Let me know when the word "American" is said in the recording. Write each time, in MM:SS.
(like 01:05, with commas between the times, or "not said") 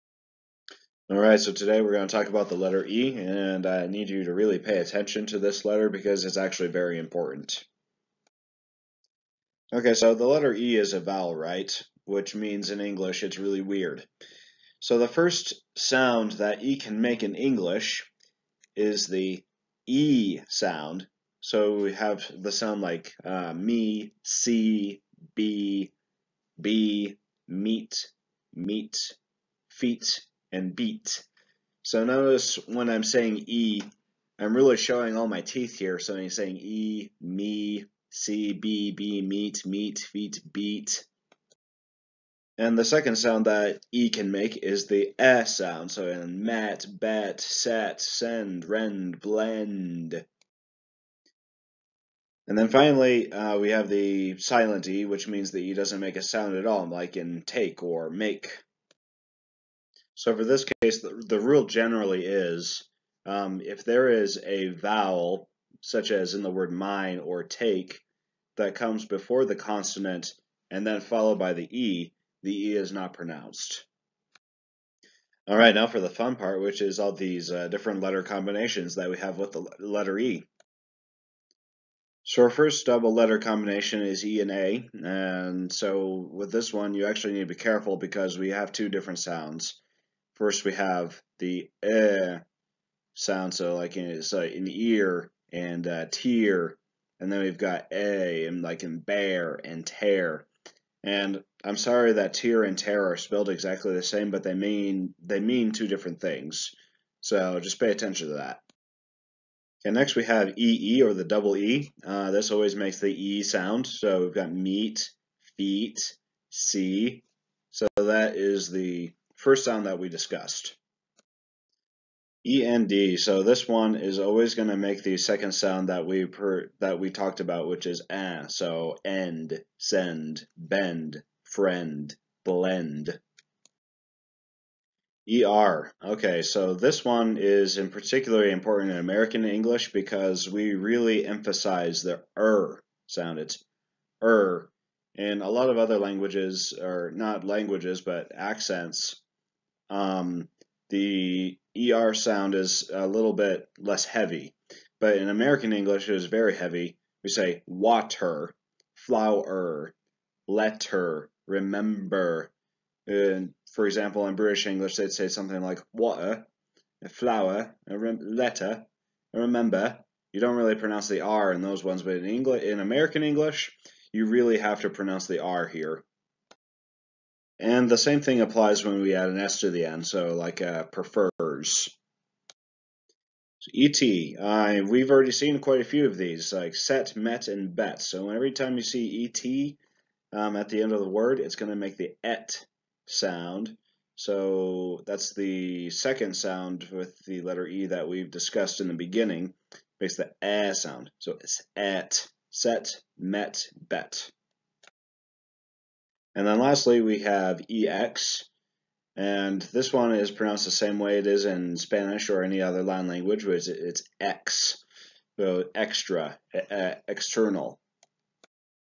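02:18, 02:35, 02:52.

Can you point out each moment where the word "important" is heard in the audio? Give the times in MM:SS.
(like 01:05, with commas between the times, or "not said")
00:06, 02:18.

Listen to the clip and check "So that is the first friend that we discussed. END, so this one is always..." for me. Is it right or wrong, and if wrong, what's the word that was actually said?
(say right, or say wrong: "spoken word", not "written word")
wrong: "sound", not "friend".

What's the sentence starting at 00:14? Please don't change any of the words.
So the first sound that E can make in English is the E sound.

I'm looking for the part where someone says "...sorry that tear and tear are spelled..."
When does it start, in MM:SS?
01:41.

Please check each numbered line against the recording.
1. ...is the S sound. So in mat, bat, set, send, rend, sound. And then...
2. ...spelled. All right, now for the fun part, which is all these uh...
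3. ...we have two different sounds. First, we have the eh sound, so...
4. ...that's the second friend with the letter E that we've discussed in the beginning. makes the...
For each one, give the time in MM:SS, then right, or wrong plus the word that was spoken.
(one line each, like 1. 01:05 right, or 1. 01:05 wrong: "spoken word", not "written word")
1. 00:44 wrong: "blend", not "sound"
2. 01:13 wrong: "pronounced", not "spelled"
3. 01:28 right
4. 03:15 wrong: "sound", not "friend".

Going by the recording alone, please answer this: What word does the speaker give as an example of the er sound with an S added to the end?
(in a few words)
prefers.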